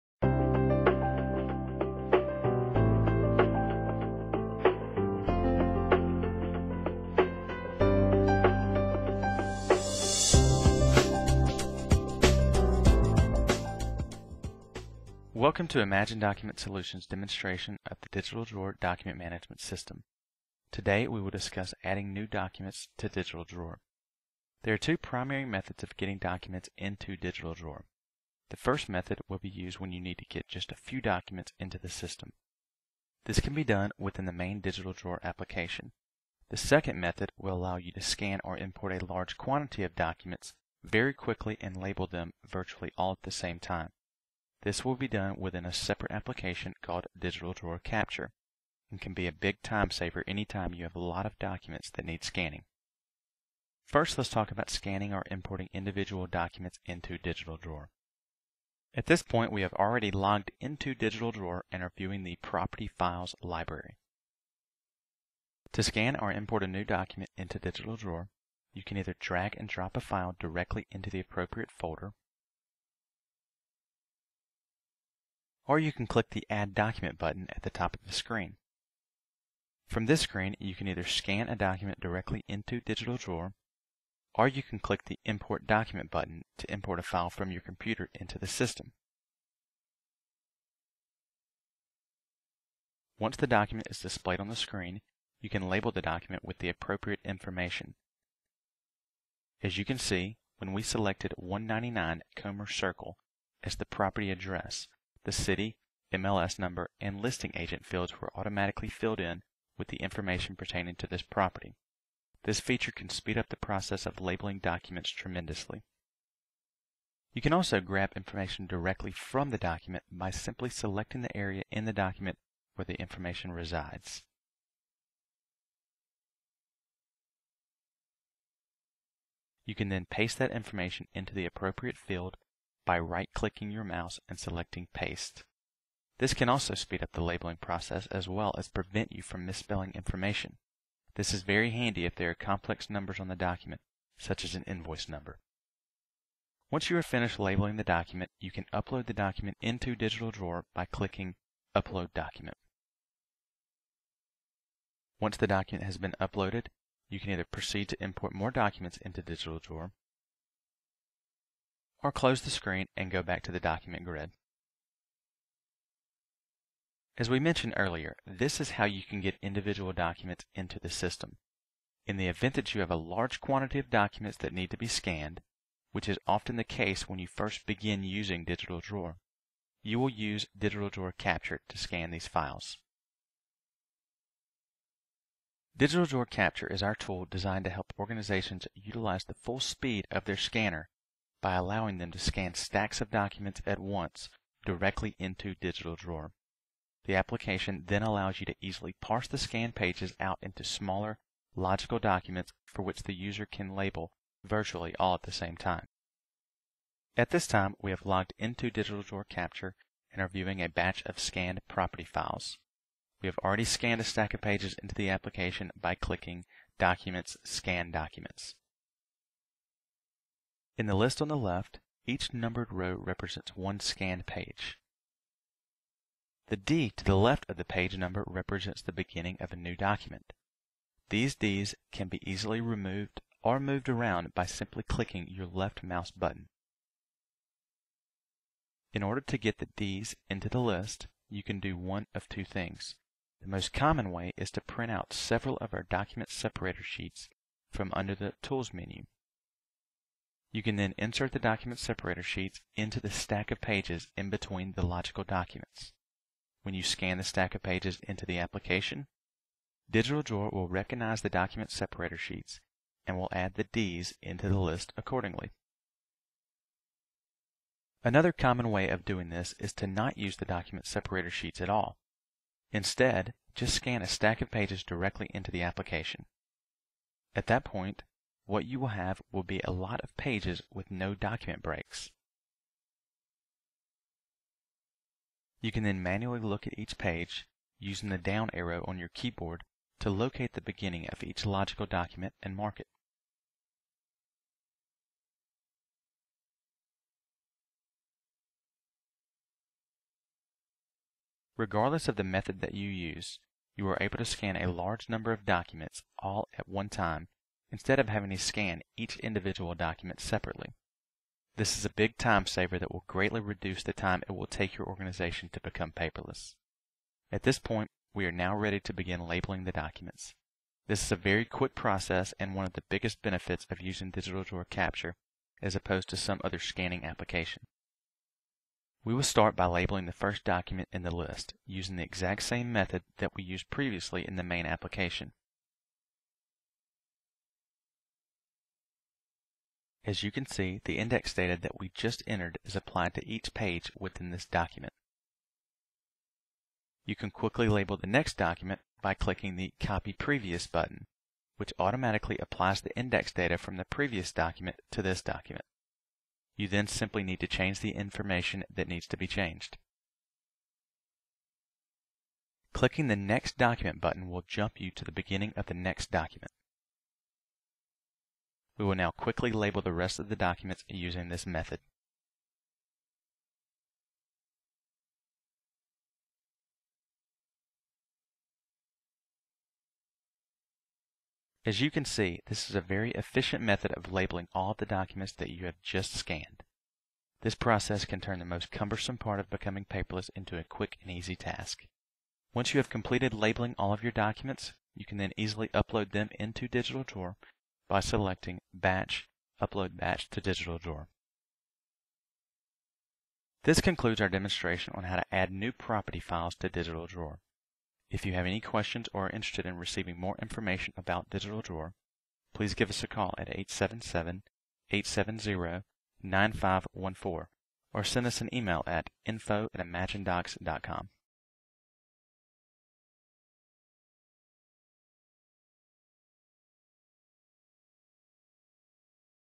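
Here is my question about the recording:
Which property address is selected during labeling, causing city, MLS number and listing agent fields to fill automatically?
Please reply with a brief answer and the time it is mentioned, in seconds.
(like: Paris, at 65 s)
199 Comer Circle, at 101 s.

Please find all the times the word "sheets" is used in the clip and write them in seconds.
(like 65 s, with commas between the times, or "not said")
246 s, 252 s, 262 s, 271 s.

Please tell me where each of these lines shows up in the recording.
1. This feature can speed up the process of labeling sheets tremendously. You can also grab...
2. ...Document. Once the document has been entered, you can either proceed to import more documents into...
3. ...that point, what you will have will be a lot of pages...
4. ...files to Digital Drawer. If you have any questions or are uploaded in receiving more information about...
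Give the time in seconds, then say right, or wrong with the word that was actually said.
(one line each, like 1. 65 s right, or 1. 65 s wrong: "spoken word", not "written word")
1. 112 s wrong: "documents", not "sheets"
2. 152 s wrong: "uploaded", not "entered"
3. 277 s right
4. 406 s wrong: "interested", not "uploaded".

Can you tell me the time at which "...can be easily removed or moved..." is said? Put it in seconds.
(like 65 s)
231 s.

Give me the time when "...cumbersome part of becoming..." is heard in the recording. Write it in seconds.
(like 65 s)
388 s.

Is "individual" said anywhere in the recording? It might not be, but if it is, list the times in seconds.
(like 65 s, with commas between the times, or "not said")
55 s, 169 s, 309 s.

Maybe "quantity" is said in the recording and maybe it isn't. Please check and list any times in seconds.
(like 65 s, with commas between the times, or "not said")
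39 s, 173 s.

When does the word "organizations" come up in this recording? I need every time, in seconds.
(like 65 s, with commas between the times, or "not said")
187 s, 314 s.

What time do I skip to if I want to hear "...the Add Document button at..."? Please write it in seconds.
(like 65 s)
76 s.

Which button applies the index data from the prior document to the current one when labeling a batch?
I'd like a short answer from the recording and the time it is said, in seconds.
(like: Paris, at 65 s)
Copy Previous, at 349 s.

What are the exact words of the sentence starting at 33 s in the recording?
This can be done within the main Digital Drawer application.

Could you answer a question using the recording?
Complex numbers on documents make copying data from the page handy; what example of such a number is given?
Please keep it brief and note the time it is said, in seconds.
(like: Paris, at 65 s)
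an invoice number, at 144 s.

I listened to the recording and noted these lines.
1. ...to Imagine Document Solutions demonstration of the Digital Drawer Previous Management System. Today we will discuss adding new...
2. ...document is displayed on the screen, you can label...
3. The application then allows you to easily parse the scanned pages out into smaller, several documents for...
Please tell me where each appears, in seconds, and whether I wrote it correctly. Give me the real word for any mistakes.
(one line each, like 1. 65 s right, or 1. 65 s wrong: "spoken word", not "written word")
1. 15 s wrong: "Document", not "Previous"
2. 93 s right
3. 197 s wrong: "logical", not "several".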